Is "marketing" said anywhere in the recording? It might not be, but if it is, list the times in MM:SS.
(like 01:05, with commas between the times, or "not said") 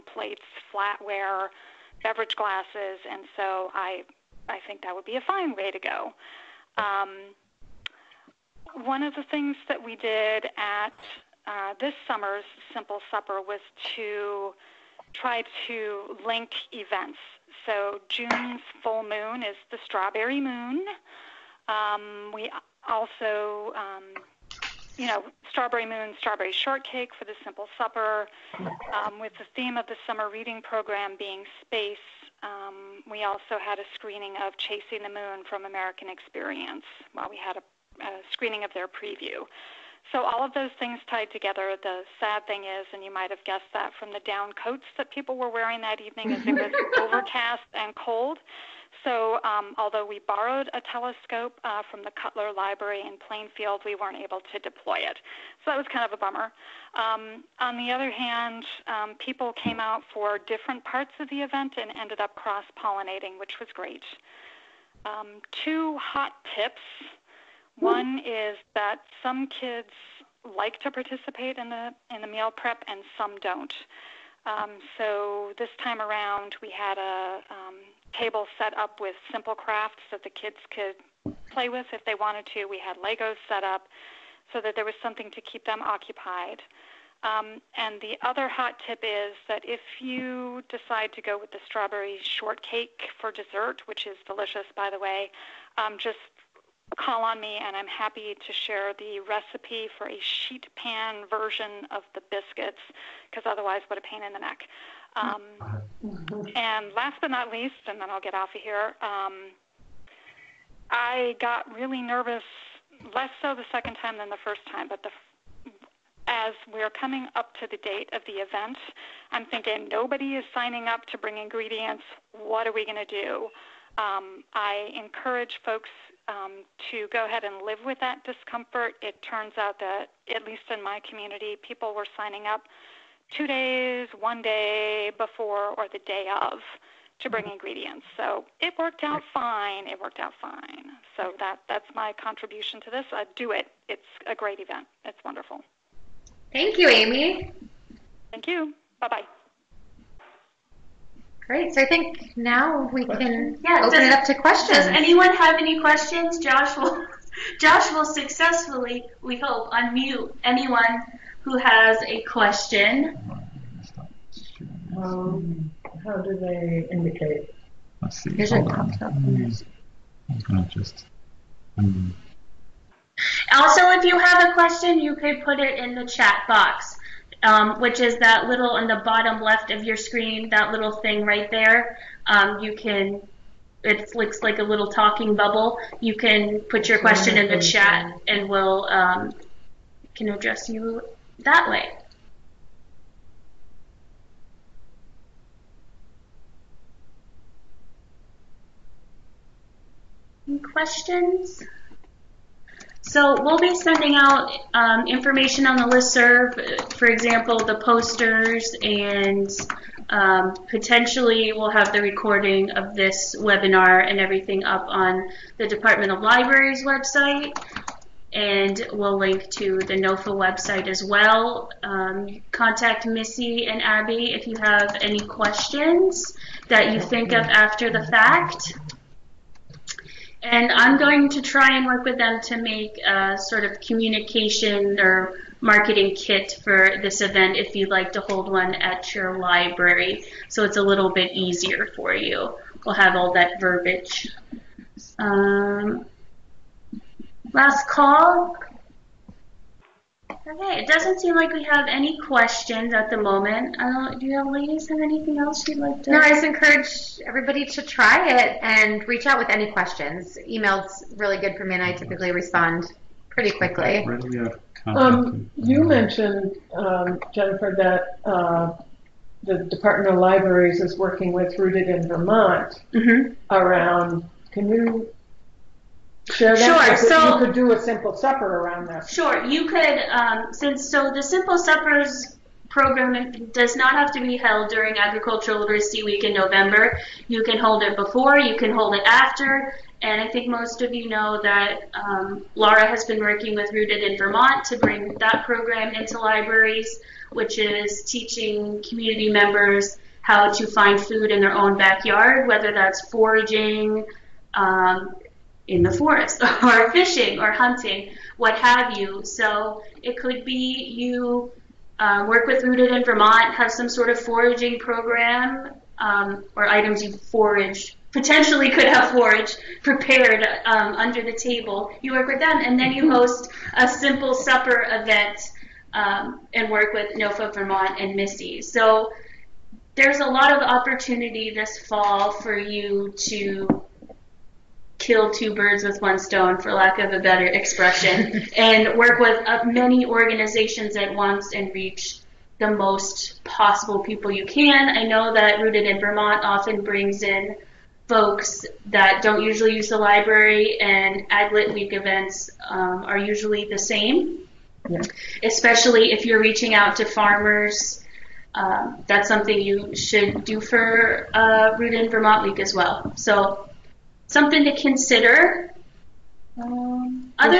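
03:55.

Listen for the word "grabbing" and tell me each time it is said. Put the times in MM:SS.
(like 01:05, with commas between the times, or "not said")
not said.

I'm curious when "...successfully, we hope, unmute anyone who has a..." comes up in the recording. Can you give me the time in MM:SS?
02:38.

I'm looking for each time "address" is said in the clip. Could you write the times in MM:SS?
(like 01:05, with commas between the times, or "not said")
03:10.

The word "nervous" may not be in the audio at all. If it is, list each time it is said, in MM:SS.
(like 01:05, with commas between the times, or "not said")
01:52.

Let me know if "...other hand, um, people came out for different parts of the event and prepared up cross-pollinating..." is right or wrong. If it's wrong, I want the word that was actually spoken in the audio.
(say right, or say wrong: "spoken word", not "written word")
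wrong: "ended", not "prepared".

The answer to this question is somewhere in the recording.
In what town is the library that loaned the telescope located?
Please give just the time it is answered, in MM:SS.
00:53.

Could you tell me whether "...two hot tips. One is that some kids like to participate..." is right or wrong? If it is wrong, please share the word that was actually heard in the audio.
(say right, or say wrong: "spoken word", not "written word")
right.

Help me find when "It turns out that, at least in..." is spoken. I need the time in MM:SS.
02:09.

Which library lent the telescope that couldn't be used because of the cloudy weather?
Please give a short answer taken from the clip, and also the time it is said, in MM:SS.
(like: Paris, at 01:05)
Cutler Library, at 00:52.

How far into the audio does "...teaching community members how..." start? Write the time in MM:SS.
04:58.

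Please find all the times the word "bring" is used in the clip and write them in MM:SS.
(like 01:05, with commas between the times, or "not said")
02:01, 02:17, 04:54, 05:46.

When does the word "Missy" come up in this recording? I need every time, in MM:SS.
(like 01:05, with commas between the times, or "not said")
03:43, 05:28.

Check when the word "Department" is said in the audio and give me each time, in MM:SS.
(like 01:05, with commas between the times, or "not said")
03:35, 04:29.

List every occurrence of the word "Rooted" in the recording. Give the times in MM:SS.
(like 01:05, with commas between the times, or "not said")
04:31, 04:53, 05:12, 05:45, 06:01.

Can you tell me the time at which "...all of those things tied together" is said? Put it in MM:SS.
00:40.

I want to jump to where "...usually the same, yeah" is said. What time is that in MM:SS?
05:53.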